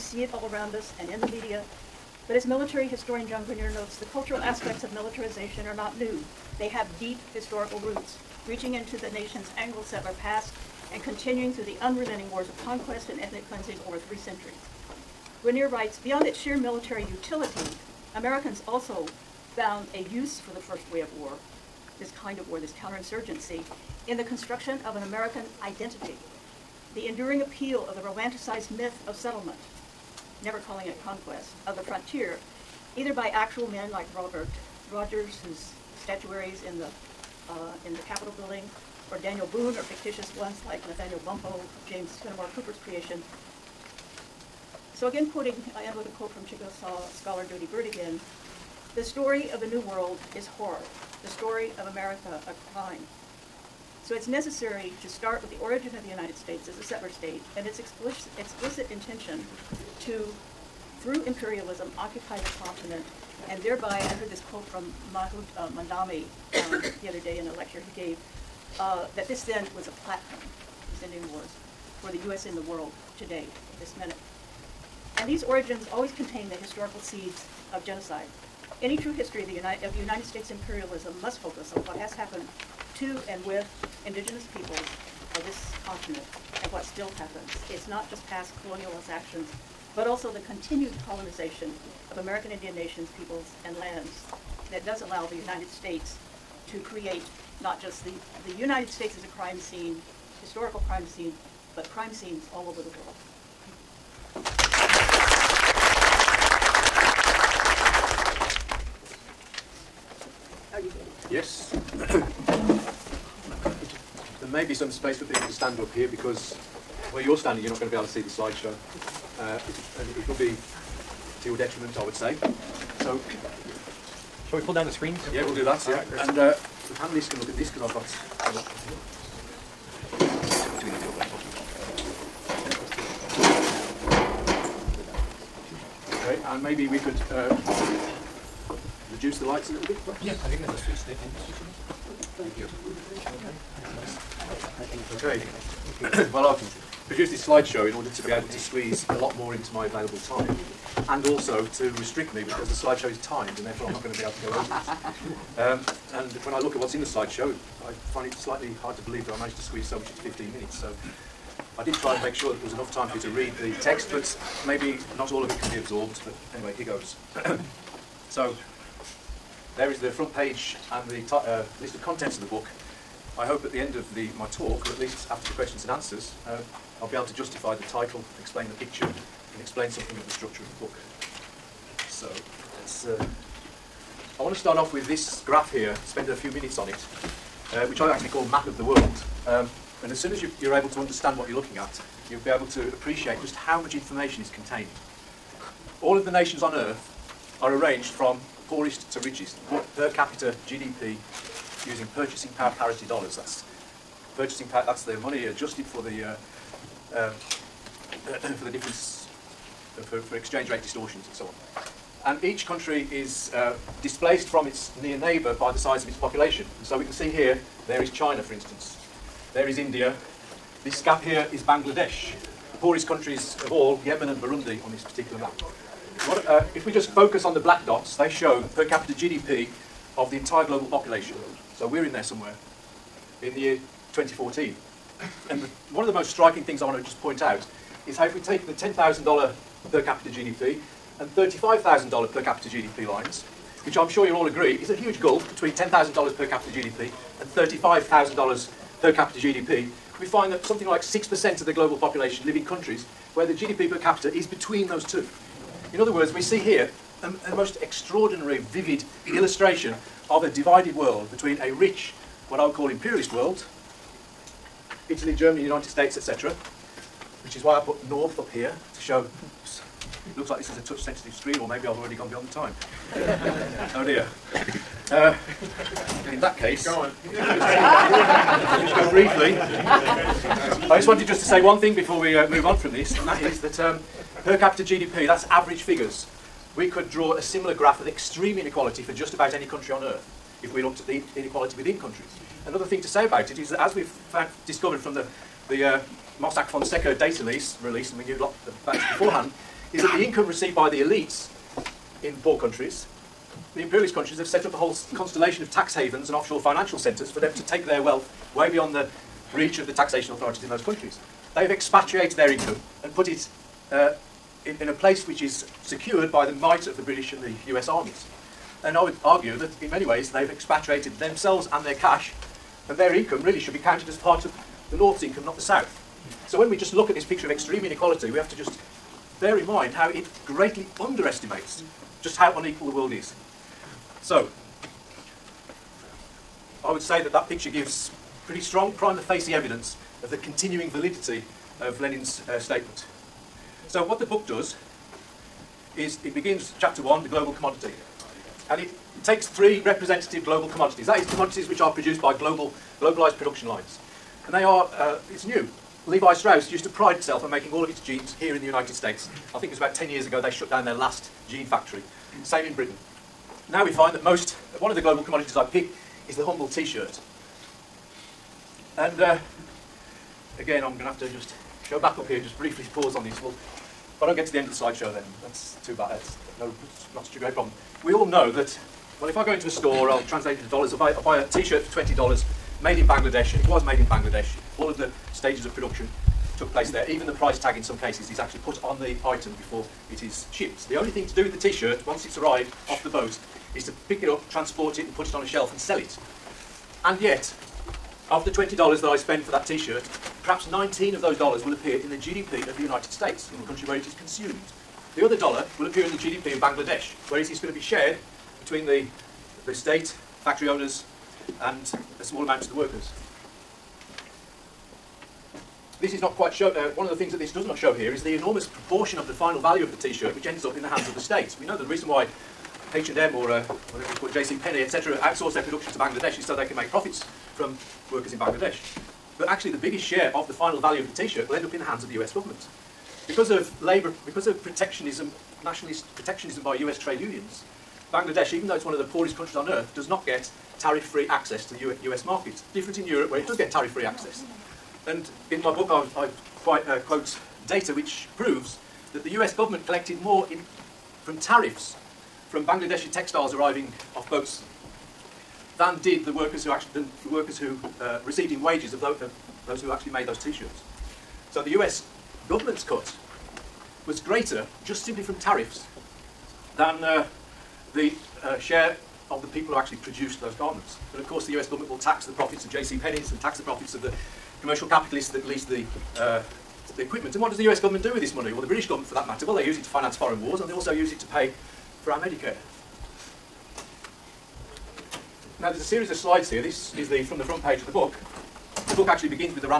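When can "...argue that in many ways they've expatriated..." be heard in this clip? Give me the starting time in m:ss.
5:19.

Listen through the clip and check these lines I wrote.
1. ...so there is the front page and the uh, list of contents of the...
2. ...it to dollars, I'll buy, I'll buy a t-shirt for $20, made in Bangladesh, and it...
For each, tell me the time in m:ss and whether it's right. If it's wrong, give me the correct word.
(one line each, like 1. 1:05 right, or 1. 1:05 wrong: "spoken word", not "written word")
1. 2:48 right
2. 6:20 right.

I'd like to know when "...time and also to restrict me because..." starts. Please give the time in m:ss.
2:30.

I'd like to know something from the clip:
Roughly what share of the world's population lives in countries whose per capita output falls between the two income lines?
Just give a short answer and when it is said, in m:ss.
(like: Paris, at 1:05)
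6%, at 4:11.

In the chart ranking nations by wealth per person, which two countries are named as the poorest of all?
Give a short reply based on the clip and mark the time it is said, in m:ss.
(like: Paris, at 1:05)
Yemen and Burundi, at 3:44.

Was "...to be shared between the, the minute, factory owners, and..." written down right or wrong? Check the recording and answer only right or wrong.
wrong.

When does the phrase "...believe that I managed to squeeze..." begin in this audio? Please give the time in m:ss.
2:39.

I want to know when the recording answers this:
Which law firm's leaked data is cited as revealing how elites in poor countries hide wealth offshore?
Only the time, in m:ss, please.
4:56.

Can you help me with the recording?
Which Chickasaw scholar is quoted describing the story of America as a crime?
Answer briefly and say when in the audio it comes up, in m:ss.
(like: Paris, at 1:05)
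Jodi Byrd, at 0:47.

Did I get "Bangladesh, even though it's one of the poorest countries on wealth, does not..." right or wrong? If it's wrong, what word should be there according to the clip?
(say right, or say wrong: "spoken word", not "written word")
wrong: "earth", not "wealth".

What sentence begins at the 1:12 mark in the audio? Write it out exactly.
in the world today, this minute.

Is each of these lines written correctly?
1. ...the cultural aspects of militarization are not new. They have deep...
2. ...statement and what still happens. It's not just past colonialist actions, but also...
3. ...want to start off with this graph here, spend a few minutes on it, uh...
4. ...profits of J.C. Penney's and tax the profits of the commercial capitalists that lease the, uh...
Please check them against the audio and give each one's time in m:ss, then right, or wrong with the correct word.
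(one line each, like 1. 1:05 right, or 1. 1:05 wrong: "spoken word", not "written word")
1. 0:03 right
2. 1:25 wrong: "continent", not "statement"
3. 3:04 right
4. 7:52 right.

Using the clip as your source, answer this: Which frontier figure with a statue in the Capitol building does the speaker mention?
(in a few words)
Robert Rogers.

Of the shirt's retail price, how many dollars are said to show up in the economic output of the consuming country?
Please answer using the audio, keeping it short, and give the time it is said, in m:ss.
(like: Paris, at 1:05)
19, at 6:40.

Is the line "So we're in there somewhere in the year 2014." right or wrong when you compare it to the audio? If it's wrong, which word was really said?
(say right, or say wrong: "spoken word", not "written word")
right.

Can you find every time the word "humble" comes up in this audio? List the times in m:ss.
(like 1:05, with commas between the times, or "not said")
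6:06.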